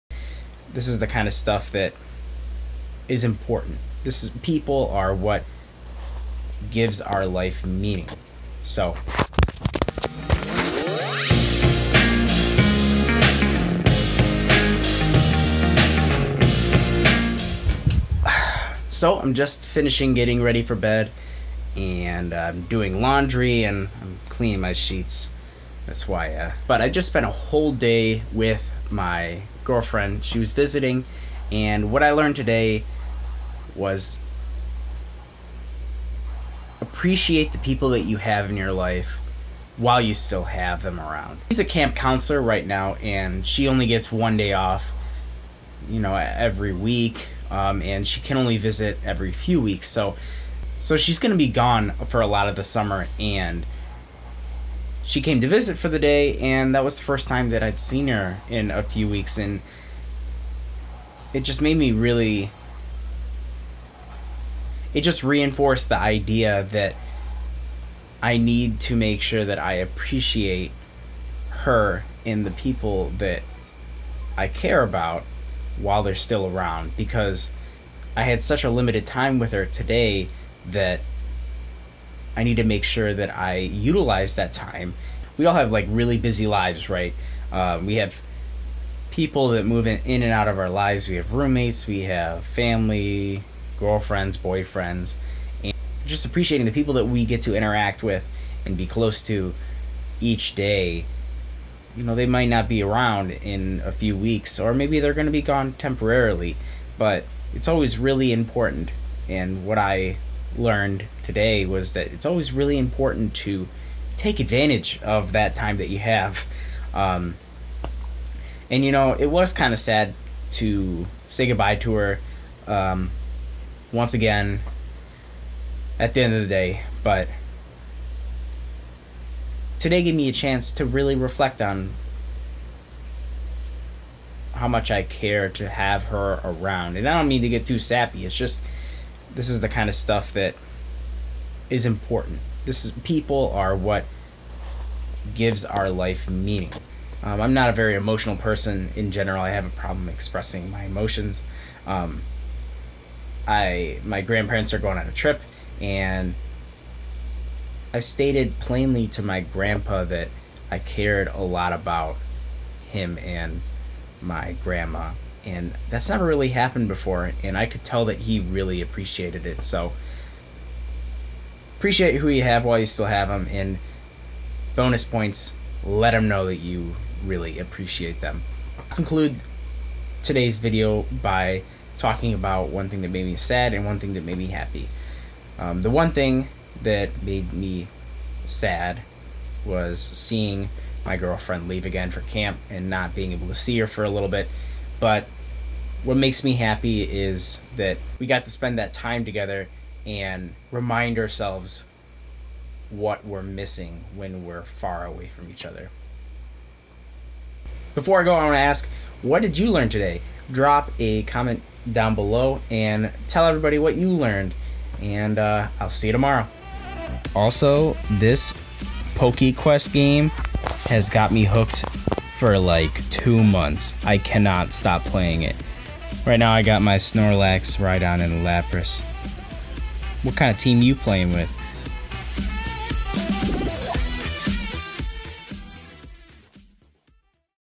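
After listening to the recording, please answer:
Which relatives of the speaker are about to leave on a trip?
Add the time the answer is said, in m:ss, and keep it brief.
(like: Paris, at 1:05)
Grandparents, at 2:34.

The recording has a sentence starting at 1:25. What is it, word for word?
We all have like really busy lives, right?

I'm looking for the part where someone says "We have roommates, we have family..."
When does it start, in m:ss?
1:31.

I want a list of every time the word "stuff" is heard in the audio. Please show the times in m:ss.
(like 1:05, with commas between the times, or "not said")
0:01, 2:19.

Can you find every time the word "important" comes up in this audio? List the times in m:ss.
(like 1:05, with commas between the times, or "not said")
0:03, 1:48, 1:52, 2:21.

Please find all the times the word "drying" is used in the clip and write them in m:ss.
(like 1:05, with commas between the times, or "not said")
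not said.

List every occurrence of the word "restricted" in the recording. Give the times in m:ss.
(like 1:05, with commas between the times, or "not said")
not said.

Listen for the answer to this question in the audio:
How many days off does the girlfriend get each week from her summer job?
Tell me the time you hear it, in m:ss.
0:44.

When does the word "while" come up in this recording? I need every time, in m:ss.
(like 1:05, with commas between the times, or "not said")
0:39, 1:15, 2:52.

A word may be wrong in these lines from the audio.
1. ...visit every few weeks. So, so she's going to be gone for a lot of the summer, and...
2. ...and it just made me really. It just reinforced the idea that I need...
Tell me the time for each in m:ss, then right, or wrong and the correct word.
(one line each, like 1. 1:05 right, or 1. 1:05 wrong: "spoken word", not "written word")
1. 0:48 right
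2. 0:59 right.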